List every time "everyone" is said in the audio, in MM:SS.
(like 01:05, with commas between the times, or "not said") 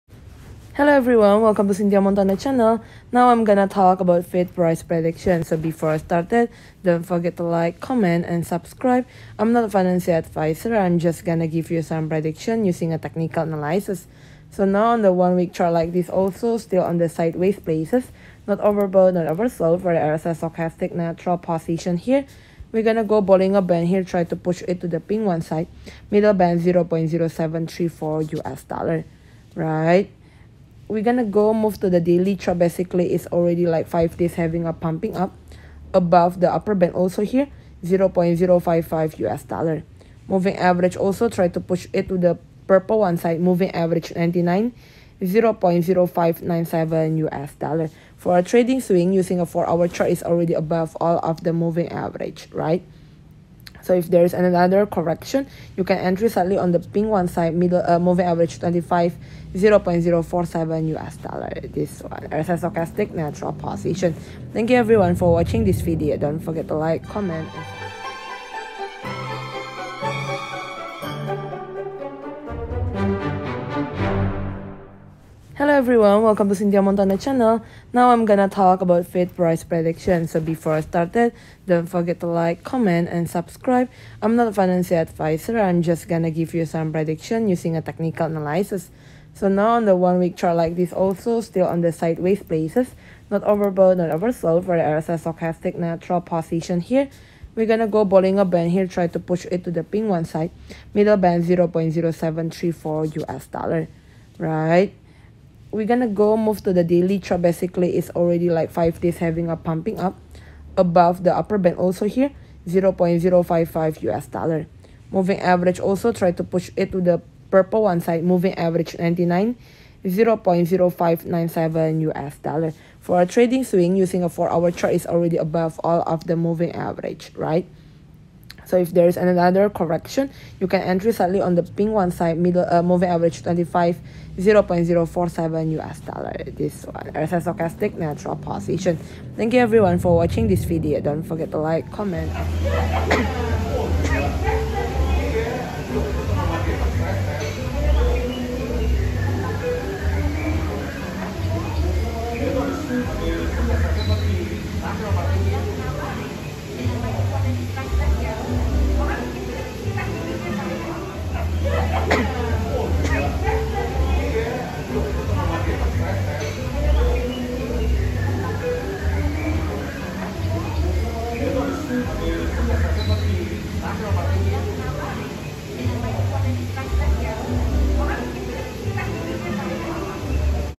00:00, 01:04, 01:15, 02:19.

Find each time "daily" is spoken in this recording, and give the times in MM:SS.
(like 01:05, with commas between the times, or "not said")
00:32, 01:46.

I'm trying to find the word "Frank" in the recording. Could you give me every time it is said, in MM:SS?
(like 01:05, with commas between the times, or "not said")
not said.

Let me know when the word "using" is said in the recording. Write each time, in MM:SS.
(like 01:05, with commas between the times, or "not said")
00:12, 00:49, 01:27, 02:03.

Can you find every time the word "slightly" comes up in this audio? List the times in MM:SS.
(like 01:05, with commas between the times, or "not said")
00:56, 02:11.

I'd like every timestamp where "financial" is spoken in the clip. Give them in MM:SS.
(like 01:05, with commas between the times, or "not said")
00:09, 01:24.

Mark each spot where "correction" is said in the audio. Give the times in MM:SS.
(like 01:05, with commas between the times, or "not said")
00:54, 02:09.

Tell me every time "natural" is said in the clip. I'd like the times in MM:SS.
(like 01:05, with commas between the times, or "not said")
00:20, 01:03, 01:35, 02:17.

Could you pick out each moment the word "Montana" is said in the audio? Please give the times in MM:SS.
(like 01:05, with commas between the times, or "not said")
00:01, 01:16.